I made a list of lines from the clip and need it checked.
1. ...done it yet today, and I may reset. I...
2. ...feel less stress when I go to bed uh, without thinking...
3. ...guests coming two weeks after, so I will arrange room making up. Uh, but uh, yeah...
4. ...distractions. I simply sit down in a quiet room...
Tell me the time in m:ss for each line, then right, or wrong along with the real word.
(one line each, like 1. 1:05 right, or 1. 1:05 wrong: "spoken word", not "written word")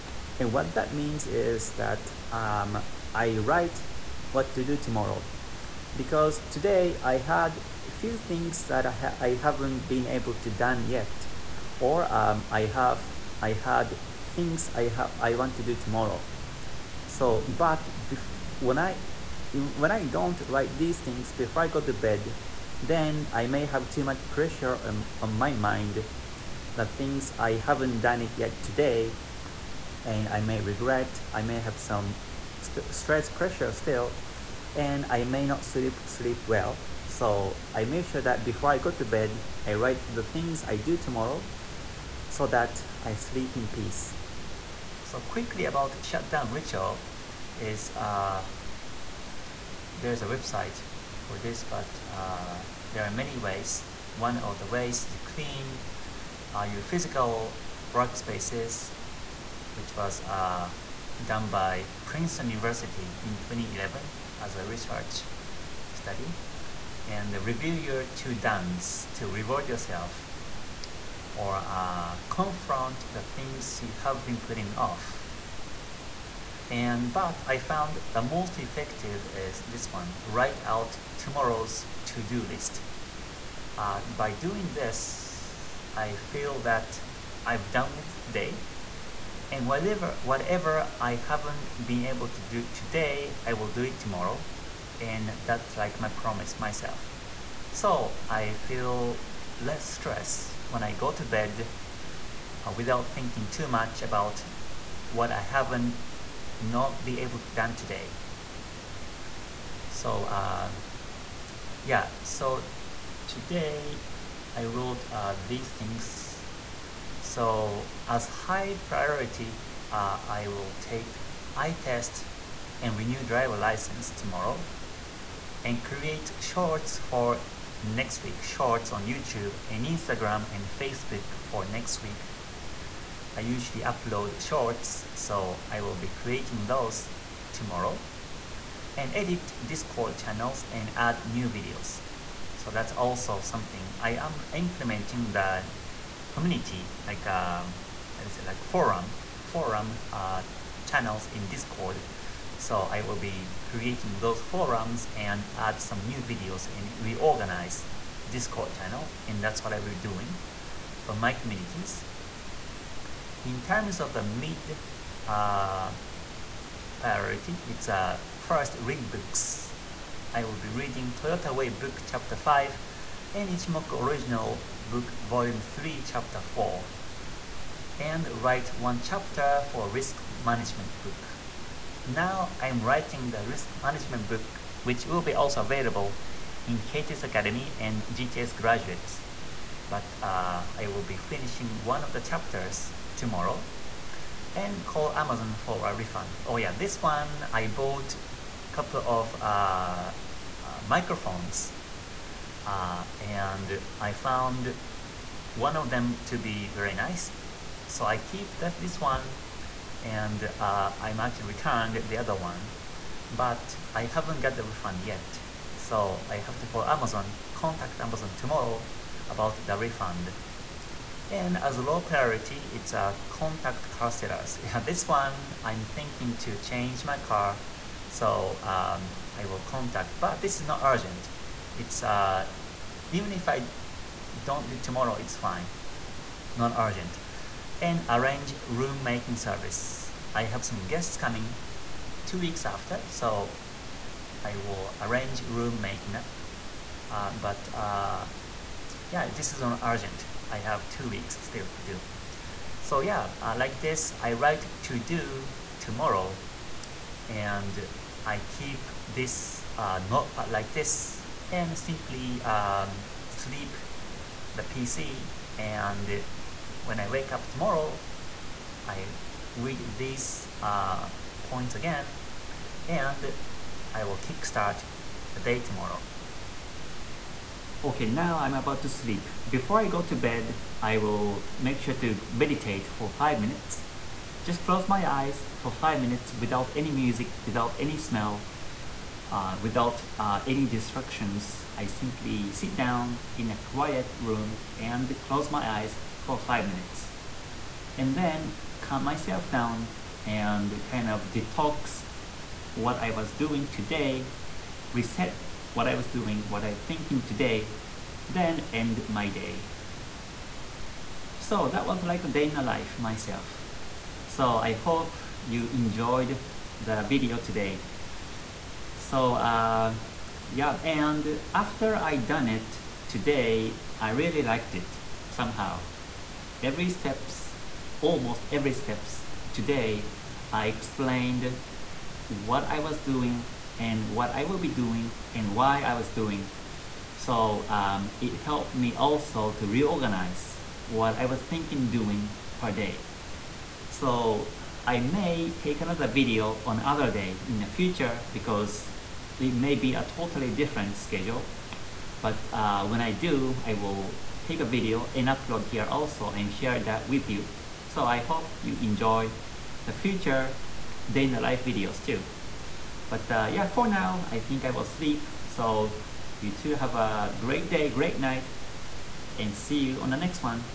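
1. 0:27 wrong: "regret", not "reset"
2. 1:38 right
3. 4:00 right
4. 4:50 right.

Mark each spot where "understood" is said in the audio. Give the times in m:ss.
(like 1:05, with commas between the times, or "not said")
not said.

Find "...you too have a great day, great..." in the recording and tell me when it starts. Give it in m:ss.
6:06.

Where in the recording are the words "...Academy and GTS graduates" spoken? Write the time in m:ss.
3:07.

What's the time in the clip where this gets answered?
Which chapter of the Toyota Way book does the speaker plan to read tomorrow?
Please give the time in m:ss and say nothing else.
2:52.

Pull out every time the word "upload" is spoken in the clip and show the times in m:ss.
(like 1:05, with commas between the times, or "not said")
2:13, 5:55.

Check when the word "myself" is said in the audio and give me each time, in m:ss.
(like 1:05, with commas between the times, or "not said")
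1:36, 4:59, 5:12.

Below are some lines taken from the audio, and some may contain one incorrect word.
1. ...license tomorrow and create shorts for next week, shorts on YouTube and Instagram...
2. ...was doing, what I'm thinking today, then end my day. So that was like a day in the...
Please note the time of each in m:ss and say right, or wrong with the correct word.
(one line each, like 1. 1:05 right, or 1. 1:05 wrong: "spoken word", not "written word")
1. 2:03 right
2. 5:05 right.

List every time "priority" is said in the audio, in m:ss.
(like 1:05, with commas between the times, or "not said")
1:58, 2:46, 3:42.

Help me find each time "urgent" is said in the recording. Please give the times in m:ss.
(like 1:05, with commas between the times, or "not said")
3:50, 3:56, 4:09.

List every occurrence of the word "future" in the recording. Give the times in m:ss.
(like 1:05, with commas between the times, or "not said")
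5:47, 5:59.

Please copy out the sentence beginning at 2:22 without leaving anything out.
So that's also something I am implementing the community, like um, how do you say, like forum, forum uh, channels in Discord.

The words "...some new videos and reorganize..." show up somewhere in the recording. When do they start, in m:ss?
2:35.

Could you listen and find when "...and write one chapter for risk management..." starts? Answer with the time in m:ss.
2:57.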